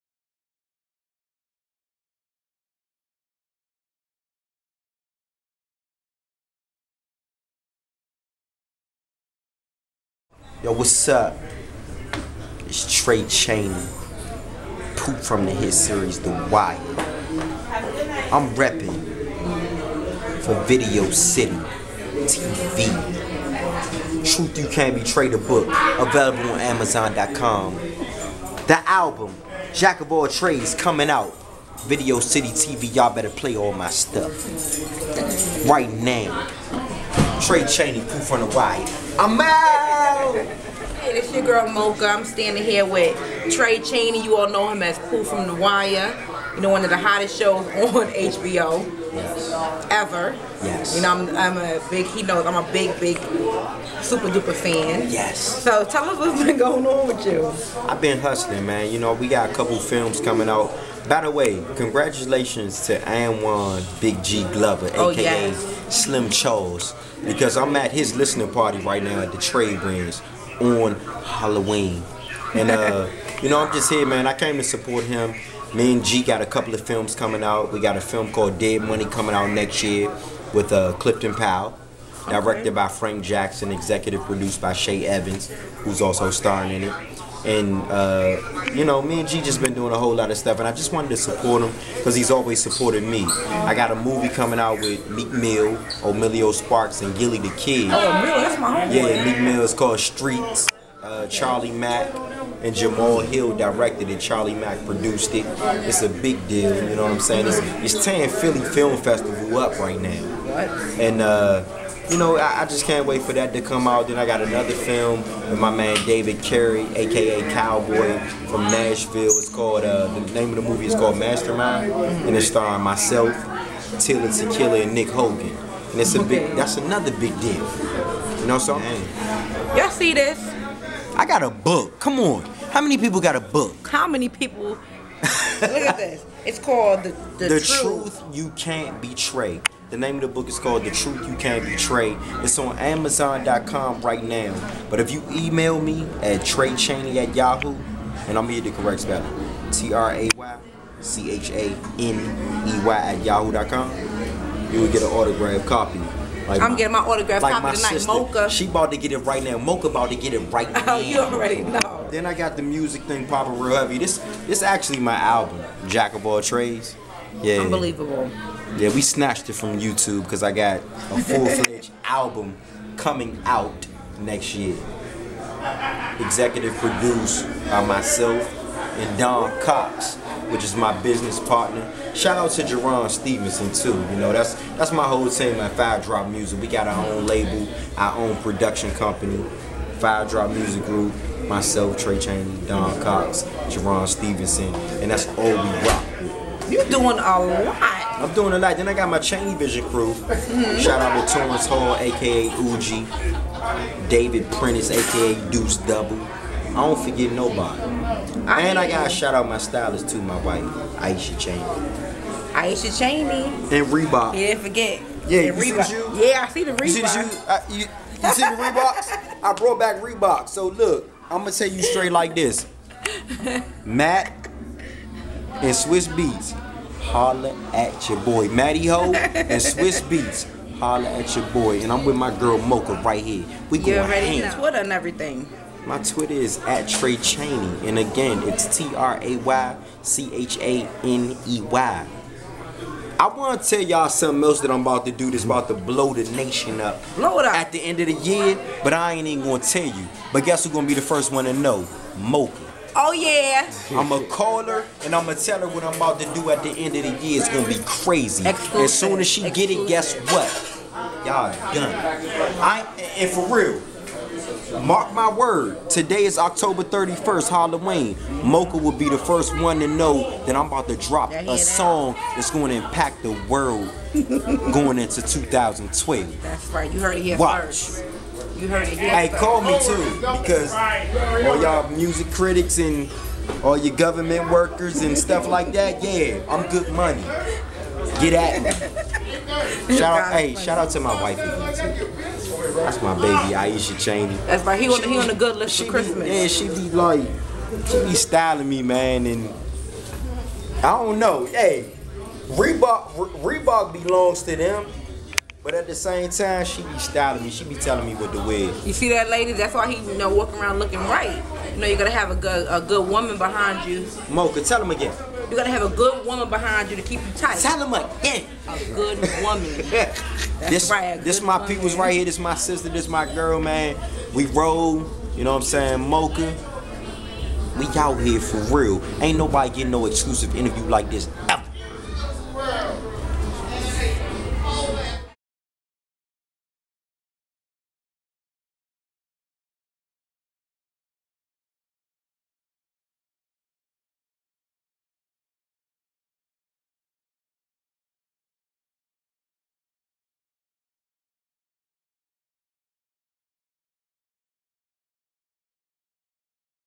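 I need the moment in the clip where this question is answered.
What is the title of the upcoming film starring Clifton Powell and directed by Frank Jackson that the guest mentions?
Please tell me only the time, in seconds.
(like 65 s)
78 s.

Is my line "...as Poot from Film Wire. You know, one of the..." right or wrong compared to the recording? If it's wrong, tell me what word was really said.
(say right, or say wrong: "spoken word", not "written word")
wrong: "The", not "Film".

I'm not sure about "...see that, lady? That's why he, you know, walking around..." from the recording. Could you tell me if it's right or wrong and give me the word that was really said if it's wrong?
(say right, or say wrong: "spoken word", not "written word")
right.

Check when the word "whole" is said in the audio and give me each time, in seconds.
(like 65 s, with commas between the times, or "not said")
89 s, 185 s.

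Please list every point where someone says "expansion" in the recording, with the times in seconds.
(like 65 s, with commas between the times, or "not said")
not said.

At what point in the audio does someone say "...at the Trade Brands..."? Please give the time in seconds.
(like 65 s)
69 s.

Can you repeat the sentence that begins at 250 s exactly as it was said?
But guess who's going to be the first one to know?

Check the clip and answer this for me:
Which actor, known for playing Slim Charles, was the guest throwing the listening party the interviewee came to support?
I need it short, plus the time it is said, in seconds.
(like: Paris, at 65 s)
Anwan Big G Glover, at 62 s.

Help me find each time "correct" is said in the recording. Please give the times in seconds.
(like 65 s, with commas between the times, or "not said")
148 s.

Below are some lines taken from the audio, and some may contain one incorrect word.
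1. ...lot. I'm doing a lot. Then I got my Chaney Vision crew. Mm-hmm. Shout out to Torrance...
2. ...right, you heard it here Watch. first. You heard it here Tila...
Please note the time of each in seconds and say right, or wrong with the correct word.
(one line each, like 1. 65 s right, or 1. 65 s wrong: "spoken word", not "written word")
1. 197 s right
2. 276 s wrong: "Hey", not "Tila".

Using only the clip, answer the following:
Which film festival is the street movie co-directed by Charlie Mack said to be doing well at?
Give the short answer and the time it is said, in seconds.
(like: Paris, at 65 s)
Philly Film Festival, at 108 s.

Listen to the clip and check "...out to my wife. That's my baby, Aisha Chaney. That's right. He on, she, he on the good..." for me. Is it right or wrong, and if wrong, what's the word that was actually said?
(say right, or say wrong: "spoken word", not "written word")
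right.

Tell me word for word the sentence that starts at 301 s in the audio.
Hey, Reebok, Reebok belongs to them.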